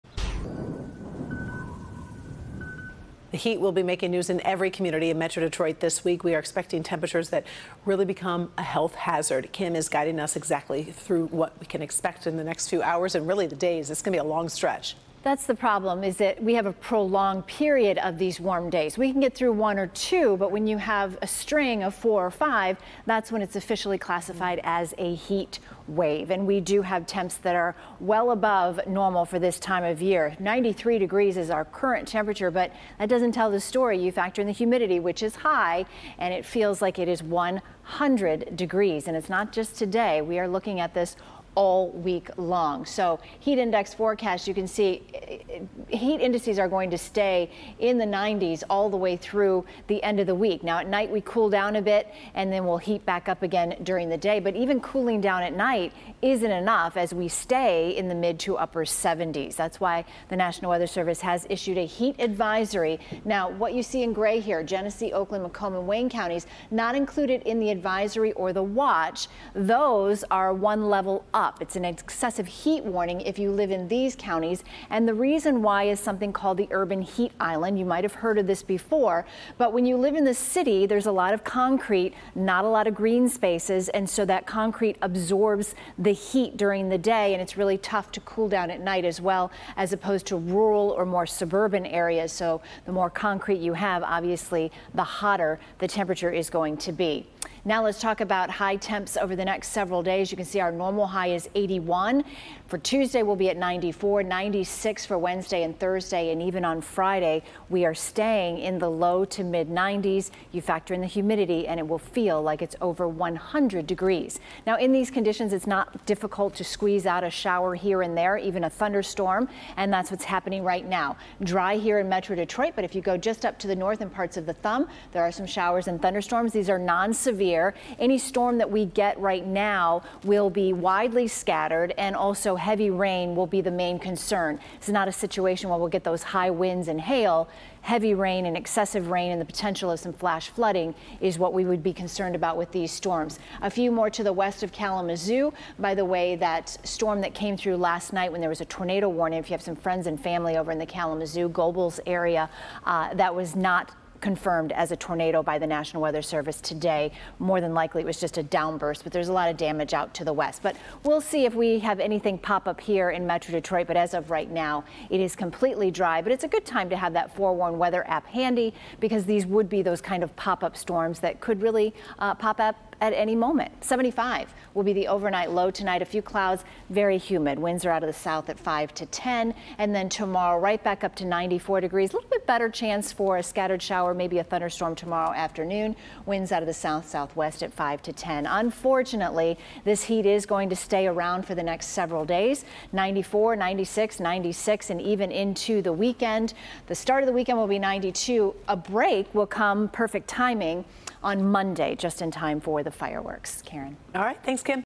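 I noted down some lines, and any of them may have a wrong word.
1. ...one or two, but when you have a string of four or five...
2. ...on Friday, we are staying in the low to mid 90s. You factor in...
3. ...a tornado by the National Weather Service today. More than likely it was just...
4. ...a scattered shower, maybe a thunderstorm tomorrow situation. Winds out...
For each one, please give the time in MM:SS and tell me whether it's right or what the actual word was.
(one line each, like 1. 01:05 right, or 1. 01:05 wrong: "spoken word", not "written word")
1. 00:19 right
2. 01:46 right
3. 02:34 right
4. 03:03 wrong: "afternoon", not "situation".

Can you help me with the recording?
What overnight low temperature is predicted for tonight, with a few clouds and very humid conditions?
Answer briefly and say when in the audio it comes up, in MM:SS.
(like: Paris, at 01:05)
75, at 02:53.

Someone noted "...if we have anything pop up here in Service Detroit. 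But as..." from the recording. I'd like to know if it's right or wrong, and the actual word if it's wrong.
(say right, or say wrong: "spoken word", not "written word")
wrong: "Metro", not "Service".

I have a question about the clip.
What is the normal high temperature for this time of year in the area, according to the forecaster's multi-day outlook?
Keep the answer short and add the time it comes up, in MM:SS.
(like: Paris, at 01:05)
81, at 01:41.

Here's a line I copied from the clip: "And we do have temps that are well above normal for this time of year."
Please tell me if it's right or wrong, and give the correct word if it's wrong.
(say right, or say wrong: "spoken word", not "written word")
right.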